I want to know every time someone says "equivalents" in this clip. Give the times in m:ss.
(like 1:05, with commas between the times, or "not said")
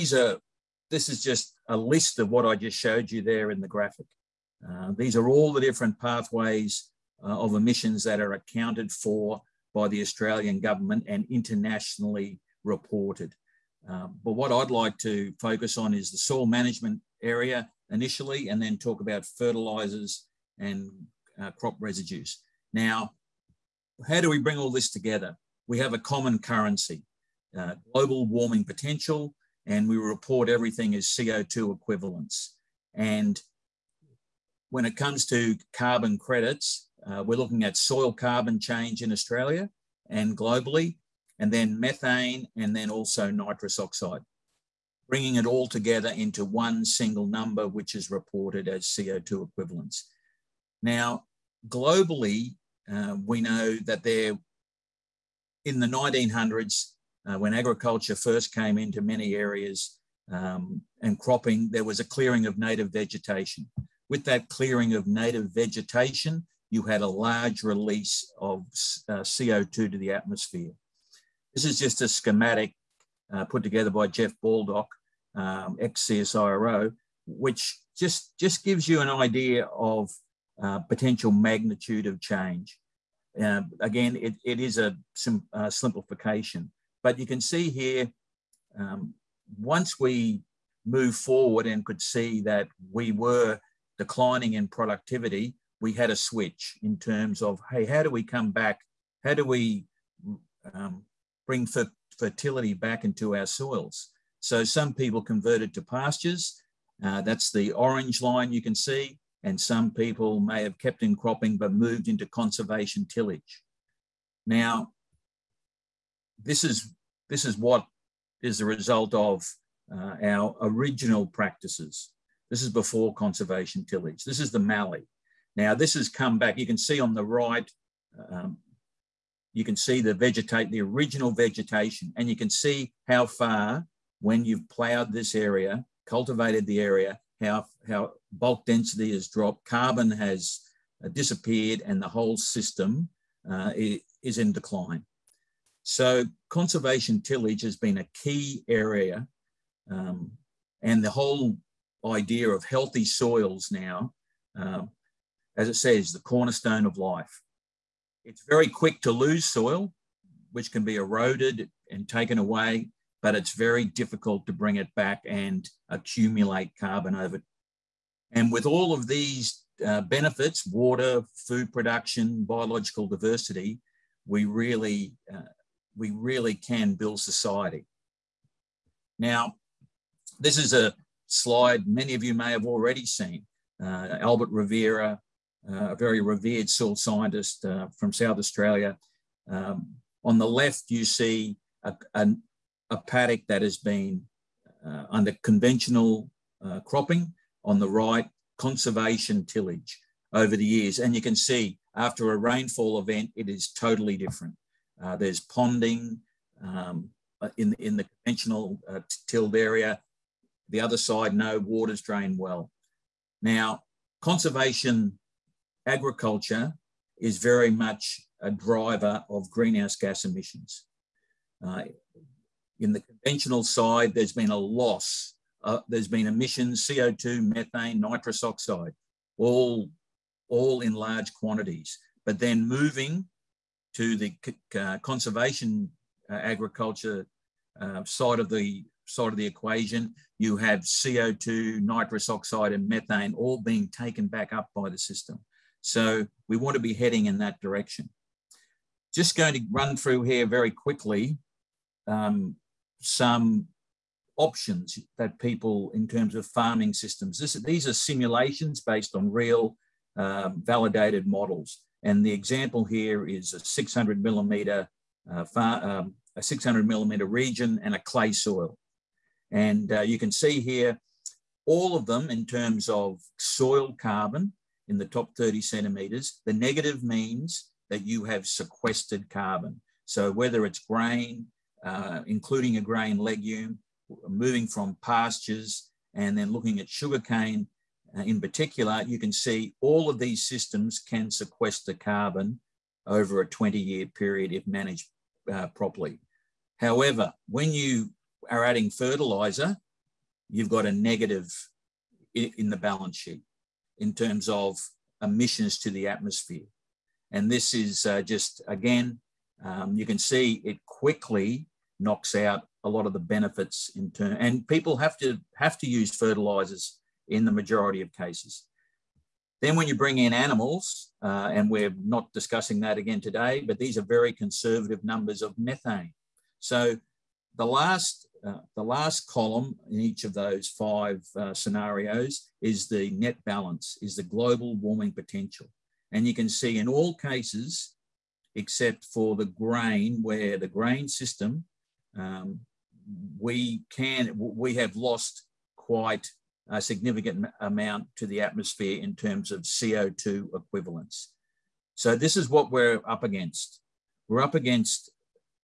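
0:31, 0:49, 5:50.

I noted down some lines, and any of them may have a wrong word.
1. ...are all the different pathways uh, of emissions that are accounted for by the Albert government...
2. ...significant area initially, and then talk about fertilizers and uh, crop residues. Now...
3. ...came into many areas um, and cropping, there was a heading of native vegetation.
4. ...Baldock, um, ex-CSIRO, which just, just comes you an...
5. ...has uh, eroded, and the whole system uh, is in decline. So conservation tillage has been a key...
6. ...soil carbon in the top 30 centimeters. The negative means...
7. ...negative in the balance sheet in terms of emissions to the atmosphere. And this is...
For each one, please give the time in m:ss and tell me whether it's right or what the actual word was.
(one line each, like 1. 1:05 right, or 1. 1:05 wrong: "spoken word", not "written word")
1. 0:05 wrong: "Australian", not "Albert"
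2. 0:16 wrong: "management", not "significant"
3. 0:58 wrong: "clearing", not "heading"
4. 1:14 wrong: "gives", not "comes"
5. 2:20 wrong: "disappeared", not "eroded"
6. 4:33 right
7. 5:00 right.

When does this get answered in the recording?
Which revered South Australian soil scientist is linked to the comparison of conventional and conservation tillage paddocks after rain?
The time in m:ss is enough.
3:04.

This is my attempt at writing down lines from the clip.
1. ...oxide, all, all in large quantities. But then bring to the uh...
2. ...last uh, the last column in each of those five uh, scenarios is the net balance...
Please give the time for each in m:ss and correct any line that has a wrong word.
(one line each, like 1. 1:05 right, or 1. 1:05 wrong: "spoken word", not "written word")
1. 3:48 wrong: "moving", not "bring"
2. 5:27 right.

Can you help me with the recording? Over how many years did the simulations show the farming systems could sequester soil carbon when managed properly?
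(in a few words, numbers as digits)
20 years.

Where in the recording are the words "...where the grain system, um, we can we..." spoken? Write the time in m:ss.
5:40.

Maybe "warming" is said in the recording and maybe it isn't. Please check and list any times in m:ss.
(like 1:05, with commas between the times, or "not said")
0:28, 5:34.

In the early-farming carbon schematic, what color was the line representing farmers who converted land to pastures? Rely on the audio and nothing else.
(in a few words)
Orange.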